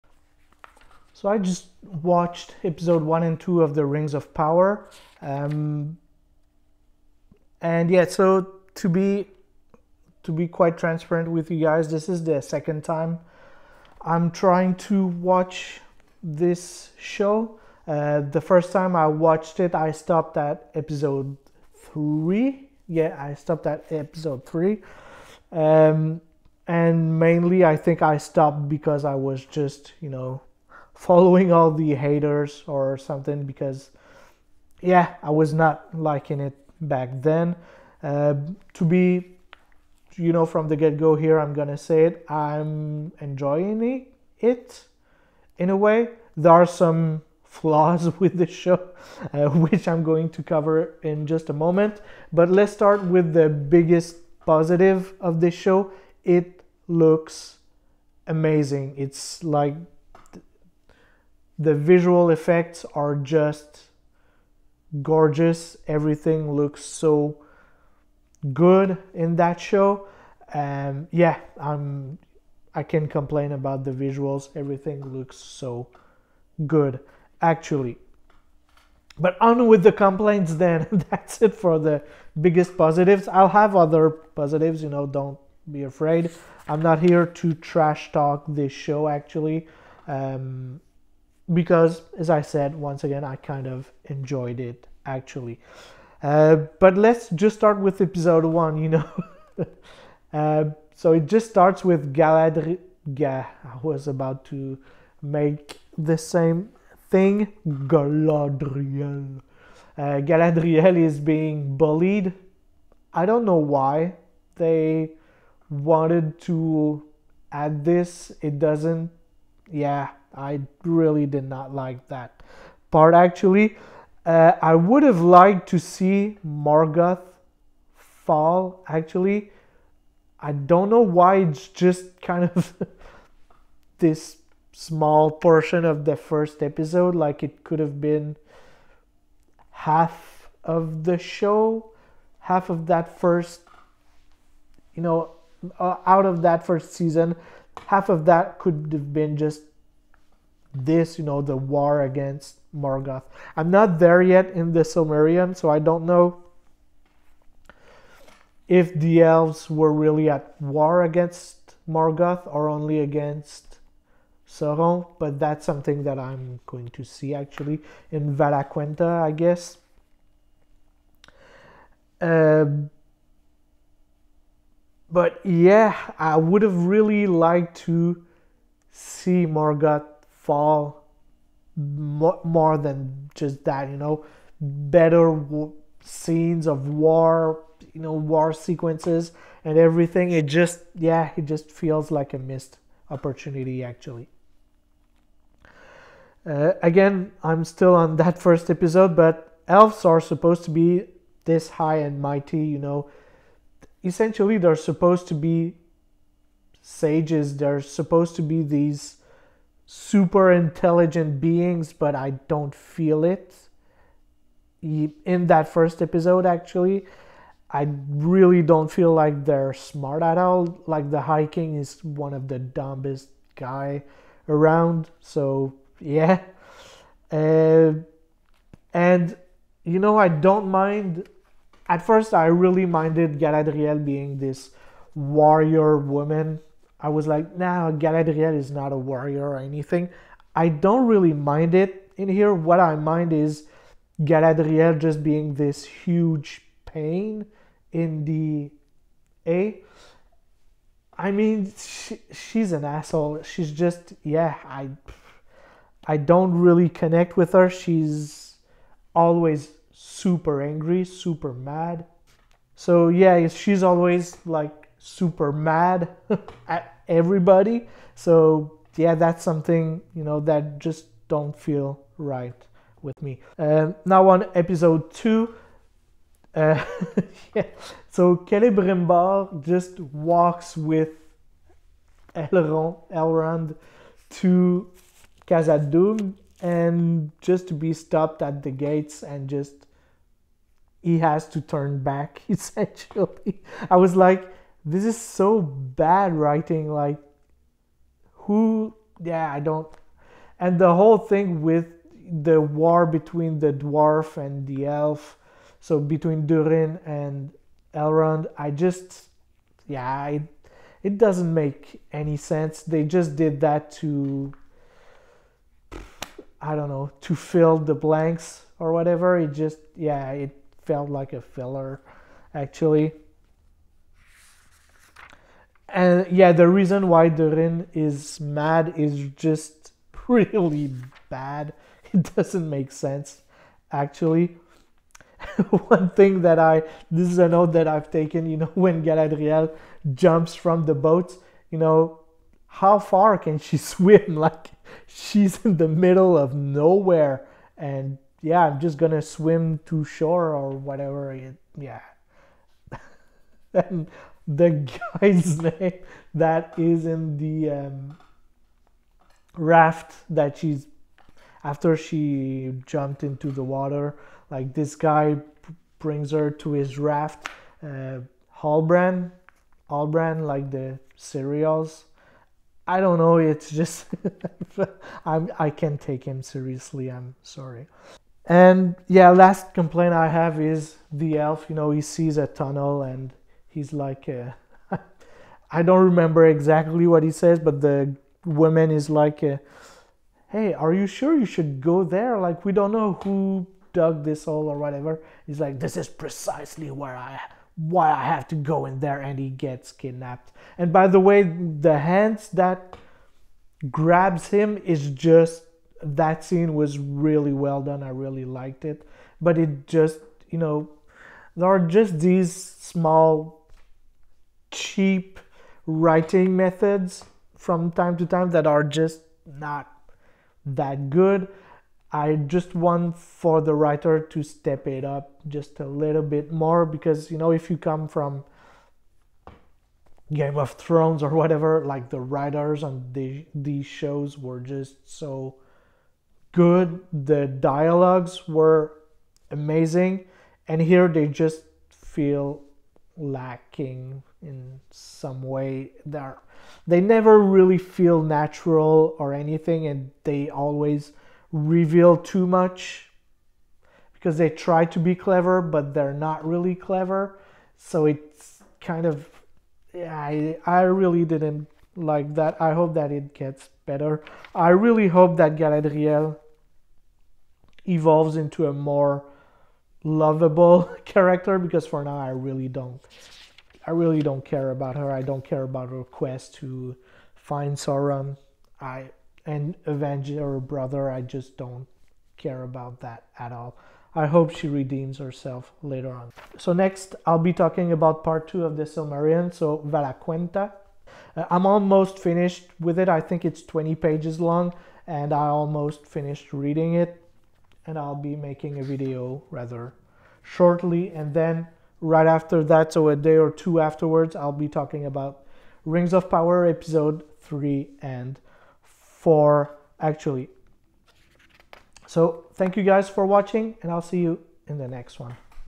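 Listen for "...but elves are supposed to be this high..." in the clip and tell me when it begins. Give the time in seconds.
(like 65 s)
199 s.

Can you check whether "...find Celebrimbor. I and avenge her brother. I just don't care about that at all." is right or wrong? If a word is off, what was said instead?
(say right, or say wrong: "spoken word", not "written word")
wrong: "Sauron", not "Celebrimbor".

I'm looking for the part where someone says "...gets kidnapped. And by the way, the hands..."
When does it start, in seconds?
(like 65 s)
399 s.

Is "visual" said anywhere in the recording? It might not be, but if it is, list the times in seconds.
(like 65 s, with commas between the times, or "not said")
61 s, 73 s.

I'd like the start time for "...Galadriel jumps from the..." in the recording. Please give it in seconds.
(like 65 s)
339 s.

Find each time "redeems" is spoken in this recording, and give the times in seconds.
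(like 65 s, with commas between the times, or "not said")
484 s.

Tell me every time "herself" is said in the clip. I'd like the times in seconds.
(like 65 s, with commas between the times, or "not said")
485 s.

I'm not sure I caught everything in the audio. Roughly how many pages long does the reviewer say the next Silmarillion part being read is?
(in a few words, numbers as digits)
20.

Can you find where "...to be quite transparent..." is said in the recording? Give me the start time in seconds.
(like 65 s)
10 s.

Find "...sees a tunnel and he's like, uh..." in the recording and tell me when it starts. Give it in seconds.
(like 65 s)
382 s.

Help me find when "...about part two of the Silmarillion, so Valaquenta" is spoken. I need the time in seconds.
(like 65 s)
487 s.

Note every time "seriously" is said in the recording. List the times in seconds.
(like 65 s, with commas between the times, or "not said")
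376 s.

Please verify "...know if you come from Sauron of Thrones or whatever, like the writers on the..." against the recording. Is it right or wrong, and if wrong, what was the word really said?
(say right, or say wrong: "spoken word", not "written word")
wrong: "Game", not "Sauron".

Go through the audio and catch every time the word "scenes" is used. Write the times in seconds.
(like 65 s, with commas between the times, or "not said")
186 s, 406 s.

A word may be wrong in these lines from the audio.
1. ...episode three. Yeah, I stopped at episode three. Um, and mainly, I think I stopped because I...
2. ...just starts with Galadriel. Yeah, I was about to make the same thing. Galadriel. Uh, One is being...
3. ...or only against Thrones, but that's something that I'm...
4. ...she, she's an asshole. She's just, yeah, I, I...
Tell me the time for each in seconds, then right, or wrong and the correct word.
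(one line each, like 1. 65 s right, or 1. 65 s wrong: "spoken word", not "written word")
1. 20 s right
2. 101 s wrong: "Galadriel", not "One"
3. 162 s wrong: "Sauron", not "Thrones"
4. 251 s right.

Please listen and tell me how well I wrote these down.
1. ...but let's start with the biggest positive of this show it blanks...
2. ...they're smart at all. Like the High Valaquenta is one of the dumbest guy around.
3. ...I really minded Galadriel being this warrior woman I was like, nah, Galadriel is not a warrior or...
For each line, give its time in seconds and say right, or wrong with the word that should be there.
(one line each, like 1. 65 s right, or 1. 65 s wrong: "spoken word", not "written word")
1. 52 s wrong: "looks", not "blanks"
2. 219 s wrong: "King", not "Valaquenta"
3. 232 s right.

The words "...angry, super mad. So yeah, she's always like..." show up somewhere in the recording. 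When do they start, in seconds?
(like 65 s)
260 s.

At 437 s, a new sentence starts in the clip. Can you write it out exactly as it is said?
The dialogues were amazing, and here they just feel lacking in some way.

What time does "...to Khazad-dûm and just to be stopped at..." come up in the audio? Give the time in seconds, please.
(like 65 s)
284 s.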